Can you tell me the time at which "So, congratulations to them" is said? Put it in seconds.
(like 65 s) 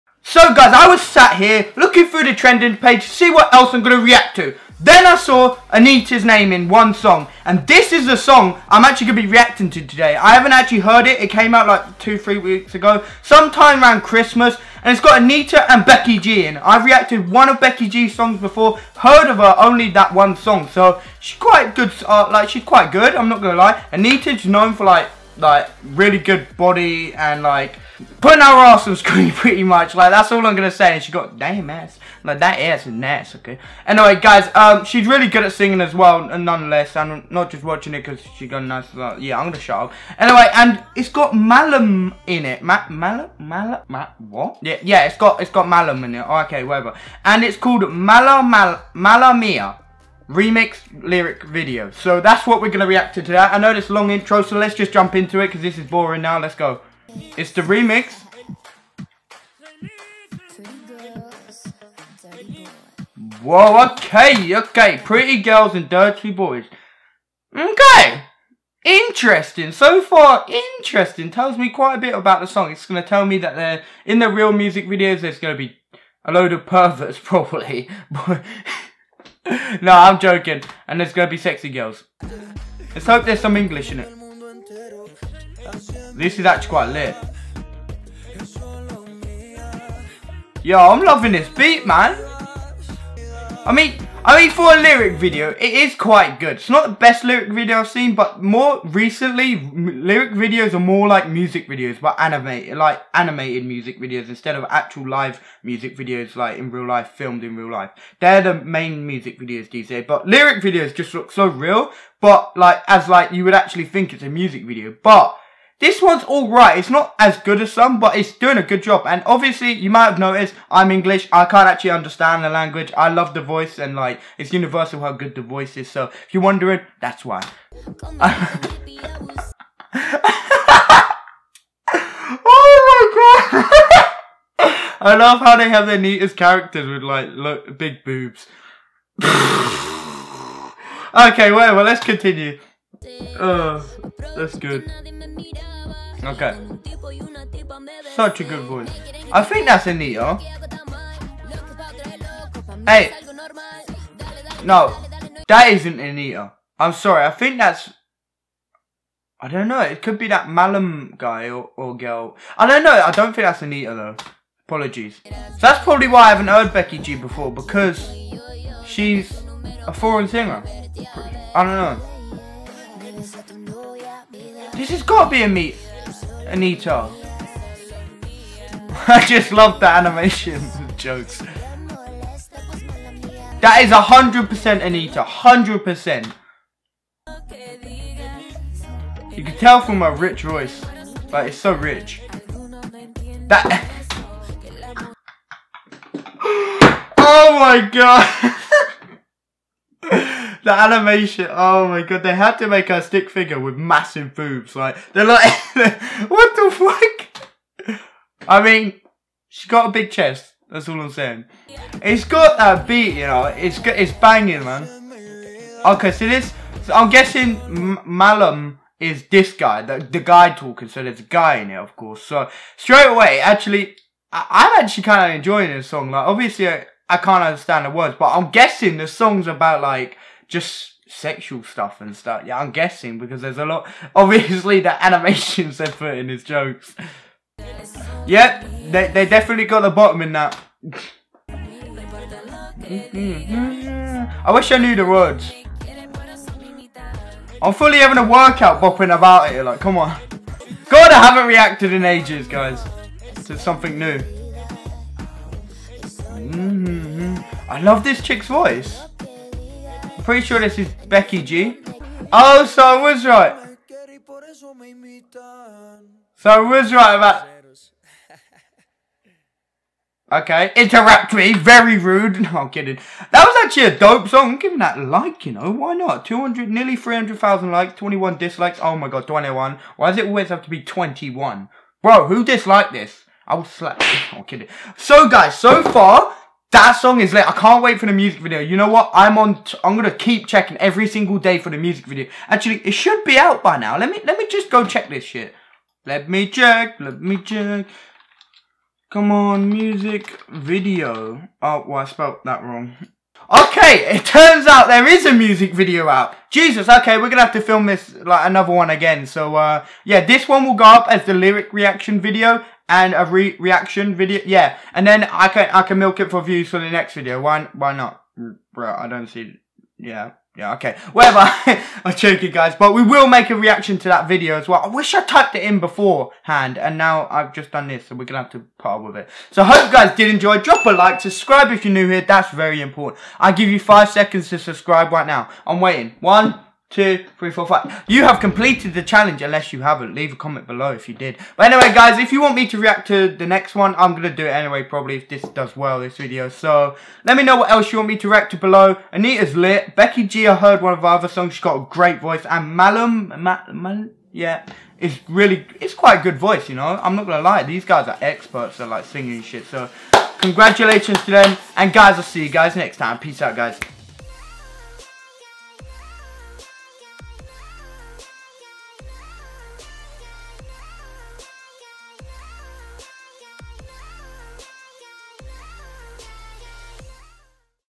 359 s.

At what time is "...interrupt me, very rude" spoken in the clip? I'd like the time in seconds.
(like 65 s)
270 s.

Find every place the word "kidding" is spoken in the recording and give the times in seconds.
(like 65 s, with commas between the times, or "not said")
272 s, 284 s.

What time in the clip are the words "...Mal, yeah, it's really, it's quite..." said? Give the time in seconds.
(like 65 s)
353 s.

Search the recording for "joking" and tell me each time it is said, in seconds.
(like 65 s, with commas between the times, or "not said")
80 s, 322 s.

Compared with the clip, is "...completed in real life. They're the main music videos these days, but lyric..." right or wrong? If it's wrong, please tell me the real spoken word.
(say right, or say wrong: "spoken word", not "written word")
wrong: "filmed", not "completed".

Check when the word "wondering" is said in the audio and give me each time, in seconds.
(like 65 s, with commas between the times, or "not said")
126 s.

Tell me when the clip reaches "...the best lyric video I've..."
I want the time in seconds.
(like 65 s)
96 s.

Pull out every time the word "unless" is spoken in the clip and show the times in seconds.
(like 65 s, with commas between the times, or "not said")
339 s.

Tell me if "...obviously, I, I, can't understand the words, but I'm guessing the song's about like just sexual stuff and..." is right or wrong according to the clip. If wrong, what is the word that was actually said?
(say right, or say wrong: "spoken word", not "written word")
right.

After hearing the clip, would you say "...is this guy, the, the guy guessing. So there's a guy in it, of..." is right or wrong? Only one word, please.
wrong.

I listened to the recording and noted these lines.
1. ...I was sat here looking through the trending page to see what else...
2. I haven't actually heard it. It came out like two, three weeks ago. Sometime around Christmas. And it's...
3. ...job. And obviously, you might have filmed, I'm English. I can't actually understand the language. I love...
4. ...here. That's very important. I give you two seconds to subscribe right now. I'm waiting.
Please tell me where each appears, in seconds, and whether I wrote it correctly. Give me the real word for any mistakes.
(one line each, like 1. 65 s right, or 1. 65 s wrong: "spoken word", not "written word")
1. 0 s right
2. 10 s right
3. 118 s wrong: "noticed", not "filmed"
4. 332 s wrong: "five", not "two".